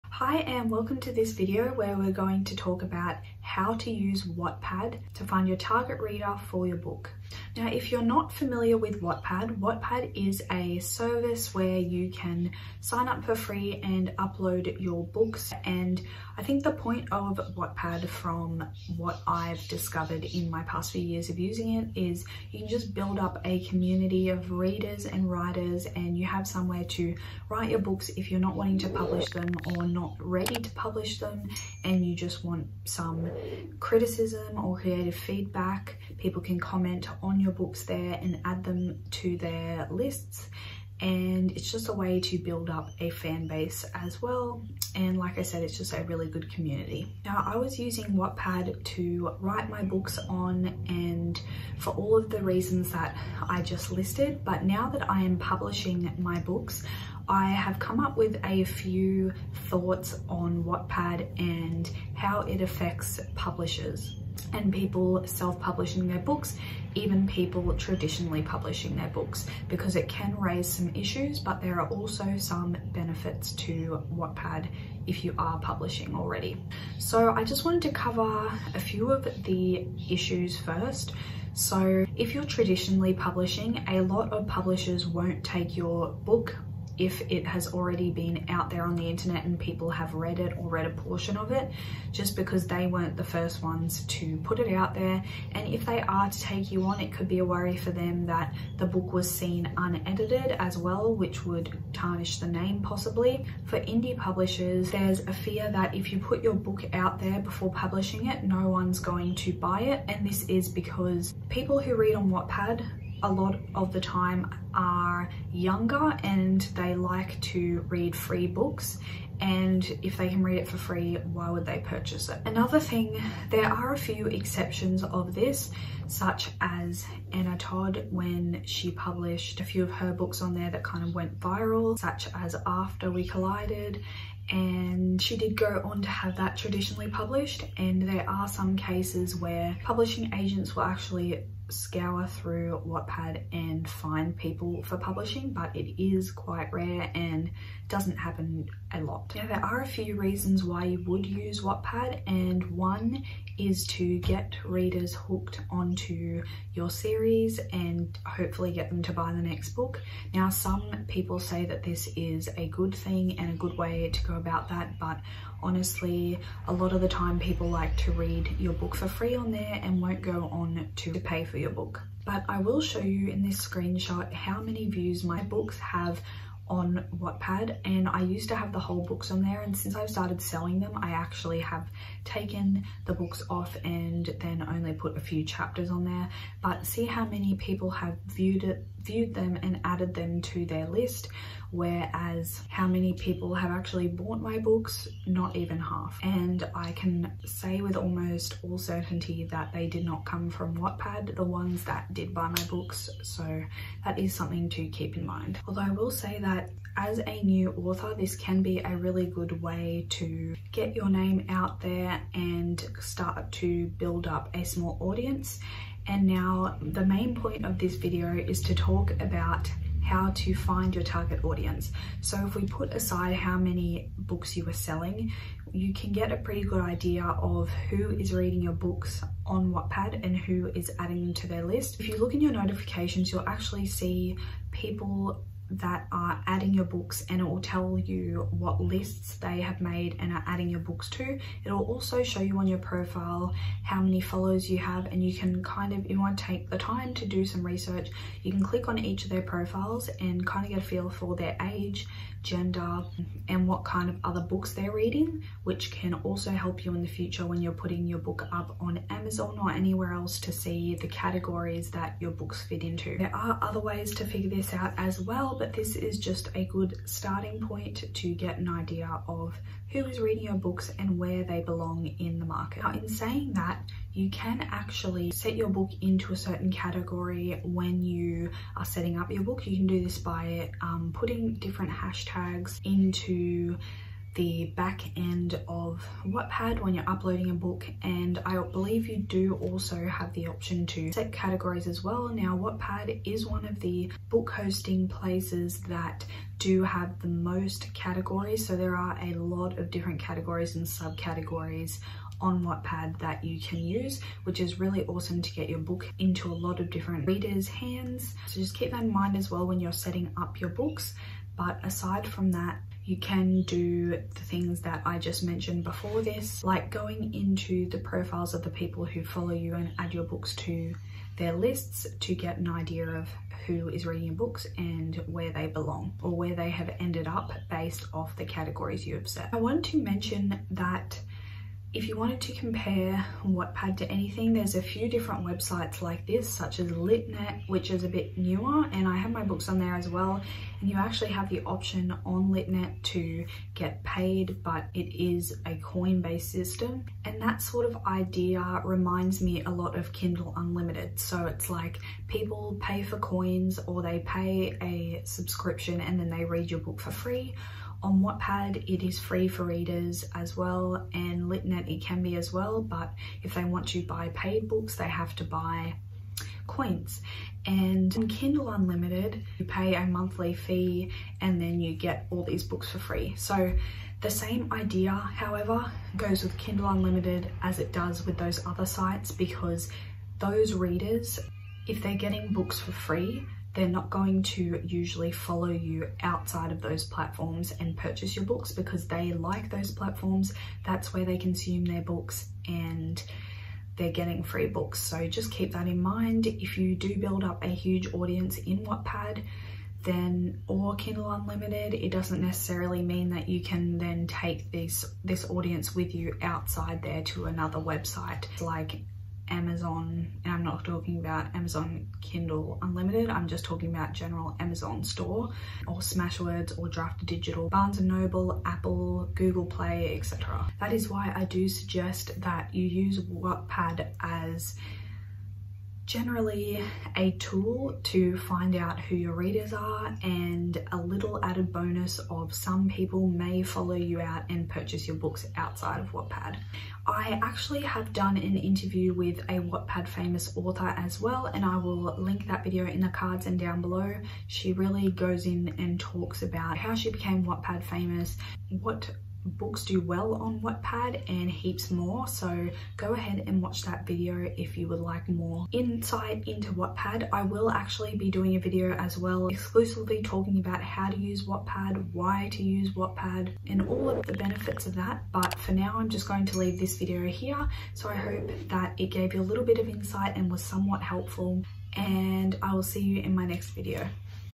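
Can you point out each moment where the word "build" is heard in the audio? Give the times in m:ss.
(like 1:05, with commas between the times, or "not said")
0:22, 0:42, 3:33, 6:37.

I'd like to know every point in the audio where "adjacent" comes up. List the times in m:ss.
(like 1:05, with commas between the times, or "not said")
not said.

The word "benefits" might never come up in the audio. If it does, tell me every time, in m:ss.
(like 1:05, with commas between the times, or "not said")
1:12, 7:44.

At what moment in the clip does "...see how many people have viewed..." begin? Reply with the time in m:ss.
3:06.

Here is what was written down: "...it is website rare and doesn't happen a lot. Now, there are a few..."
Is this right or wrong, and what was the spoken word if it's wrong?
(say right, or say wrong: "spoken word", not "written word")
wrong: "quite", not "website".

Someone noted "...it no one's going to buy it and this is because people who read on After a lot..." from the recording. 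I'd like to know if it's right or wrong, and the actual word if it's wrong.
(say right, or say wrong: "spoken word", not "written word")
wrong: "Wattpad", not "After".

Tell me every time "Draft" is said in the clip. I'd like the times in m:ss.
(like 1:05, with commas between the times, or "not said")
6:56.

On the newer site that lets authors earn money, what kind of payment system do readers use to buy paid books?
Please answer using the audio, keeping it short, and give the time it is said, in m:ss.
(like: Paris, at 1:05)
coin-based system, at 5:45.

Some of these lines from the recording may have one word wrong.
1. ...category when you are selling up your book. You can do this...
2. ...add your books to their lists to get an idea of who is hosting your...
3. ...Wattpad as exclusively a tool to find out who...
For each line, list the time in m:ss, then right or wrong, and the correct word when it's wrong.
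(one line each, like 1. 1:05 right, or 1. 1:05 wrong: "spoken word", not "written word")
1. 4:36 wrong: "setting", not "selling"
2. 5:19 wrong: "reading", not "hosting"
3. 7:03 wrong: "generally", not "exclusively".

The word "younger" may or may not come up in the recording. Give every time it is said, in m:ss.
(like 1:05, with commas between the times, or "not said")
1:55.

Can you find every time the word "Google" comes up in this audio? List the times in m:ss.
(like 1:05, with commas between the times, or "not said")
6:59.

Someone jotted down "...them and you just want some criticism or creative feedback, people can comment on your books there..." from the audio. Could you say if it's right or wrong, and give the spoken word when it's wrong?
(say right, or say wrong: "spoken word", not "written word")
right.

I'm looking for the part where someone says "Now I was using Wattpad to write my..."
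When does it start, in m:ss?
0:47.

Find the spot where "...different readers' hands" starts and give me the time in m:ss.
5:06.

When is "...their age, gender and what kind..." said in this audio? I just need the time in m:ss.
4:11.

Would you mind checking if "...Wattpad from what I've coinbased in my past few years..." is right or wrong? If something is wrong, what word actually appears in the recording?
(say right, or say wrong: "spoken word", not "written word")
wrong: "discovered", not "coinbased".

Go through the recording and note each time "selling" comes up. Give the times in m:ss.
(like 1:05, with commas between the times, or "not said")
3:00, 3:44.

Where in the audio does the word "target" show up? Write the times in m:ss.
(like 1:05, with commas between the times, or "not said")
0:05, 3:41.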